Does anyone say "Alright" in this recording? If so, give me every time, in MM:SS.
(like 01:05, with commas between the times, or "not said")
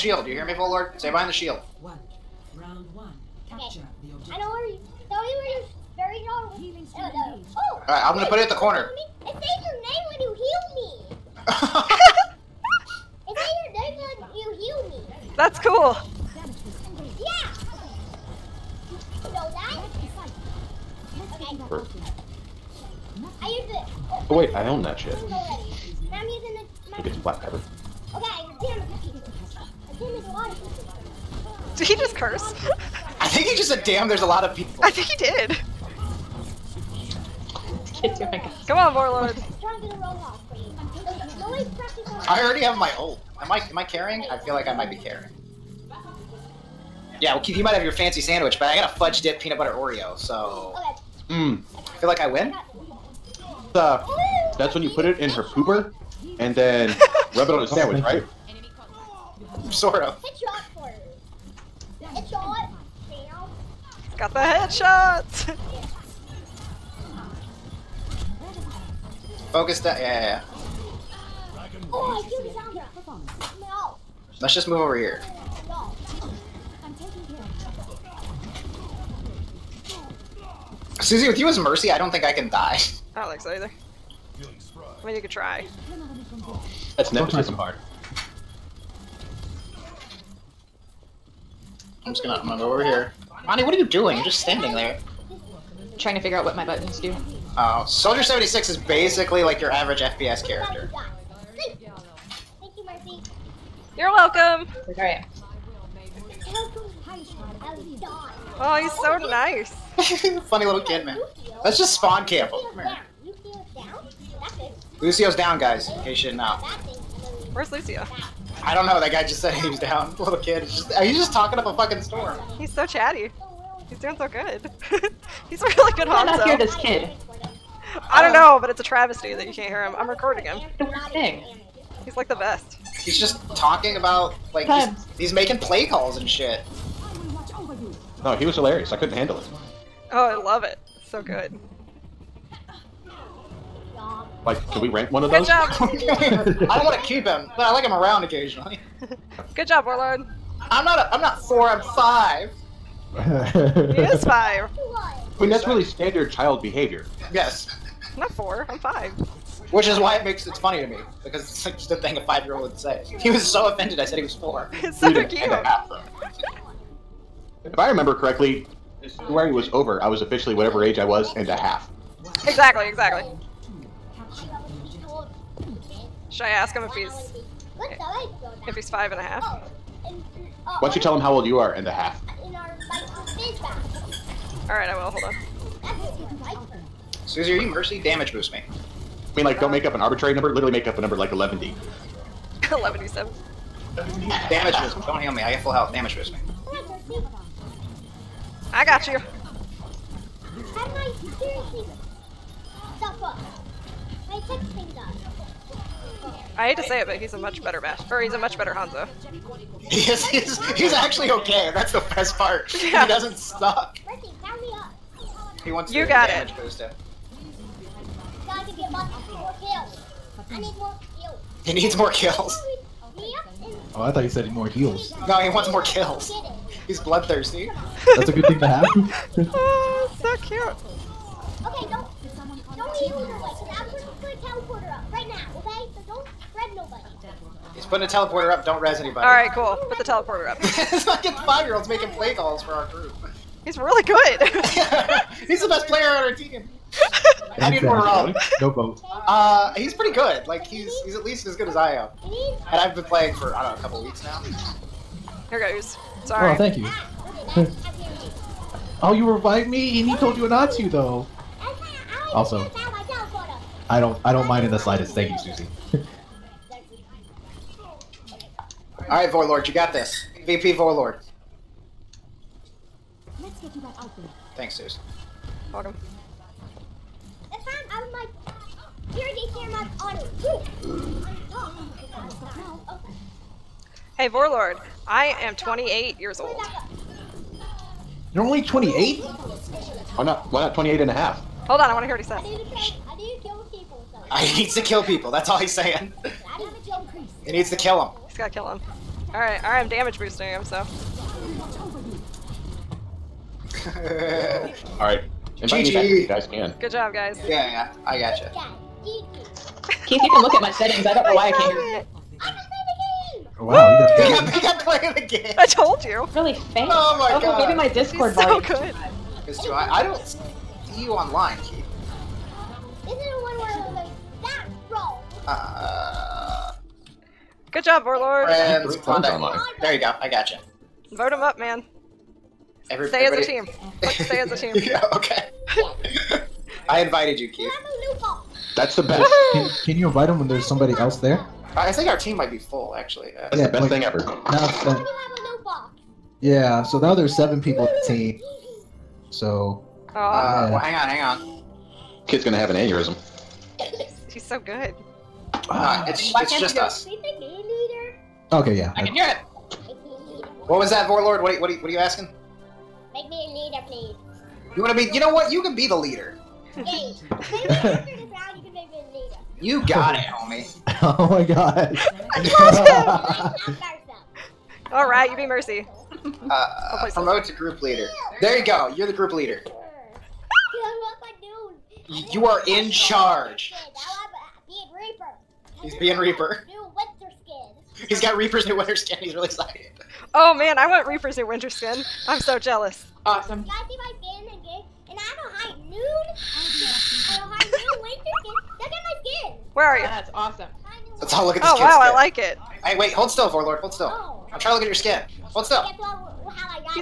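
00:07, 01:44, 03:04, 03:59.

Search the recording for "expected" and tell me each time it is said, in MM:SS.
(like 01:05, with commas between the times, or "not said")
not said.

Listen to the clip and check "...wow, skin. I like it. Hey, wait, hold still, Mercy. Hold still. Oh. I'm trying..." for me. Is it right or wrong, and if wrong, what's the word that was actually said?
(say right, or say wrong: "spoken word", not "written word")
wrong: "Vorlord", not "Mercy".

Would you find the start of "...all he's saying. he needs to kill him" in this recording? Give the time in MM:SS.
04:55.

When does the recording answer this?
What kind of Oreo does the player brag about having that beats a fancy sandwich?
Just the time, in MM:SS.
00:48.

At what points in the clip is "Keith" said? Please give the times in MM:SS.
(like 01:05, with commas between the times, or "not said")
00:47, 05:10, 05:21, 05:37.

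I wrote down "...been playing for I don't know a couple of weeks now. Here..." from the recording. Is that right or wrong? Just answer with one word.
right.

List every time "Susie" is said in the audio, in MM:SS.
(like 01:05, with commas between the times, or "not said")
01:20, 03:07, 04:25.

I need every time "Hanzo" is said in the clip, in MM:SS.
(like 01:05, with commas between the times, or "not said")
02:06, 03:28.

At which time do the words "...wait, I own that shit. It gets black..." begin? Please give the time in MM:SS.
00:24.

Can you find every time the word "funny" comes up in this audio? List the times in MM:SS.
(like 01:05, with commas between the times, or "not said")
01:50, 02:40.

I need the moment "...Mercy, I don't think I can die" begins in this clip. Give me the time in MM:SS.
01:21.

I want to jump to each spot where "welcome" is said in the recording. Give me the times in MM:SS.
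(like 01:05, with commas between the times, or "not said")
01:44, 04:35.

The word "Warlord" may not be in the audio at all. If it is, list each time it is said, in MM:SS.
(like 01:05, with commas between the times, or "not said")
00:38, 02:29, 05:28.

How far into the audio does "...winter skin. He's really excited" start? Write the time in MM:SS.
06:28.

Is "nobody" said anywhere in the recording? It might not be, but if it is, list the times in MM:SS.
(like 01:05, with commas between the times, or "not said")
03:56.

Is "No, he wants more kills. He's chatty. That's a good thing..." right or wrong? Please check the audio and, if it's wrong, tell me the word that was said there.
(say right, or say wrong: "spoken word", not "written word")
wrong: "bloodthirsty", not "chatty".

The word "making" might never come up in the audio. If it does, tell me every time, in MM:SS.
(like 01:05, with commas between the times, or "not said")
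02:15, 04:01.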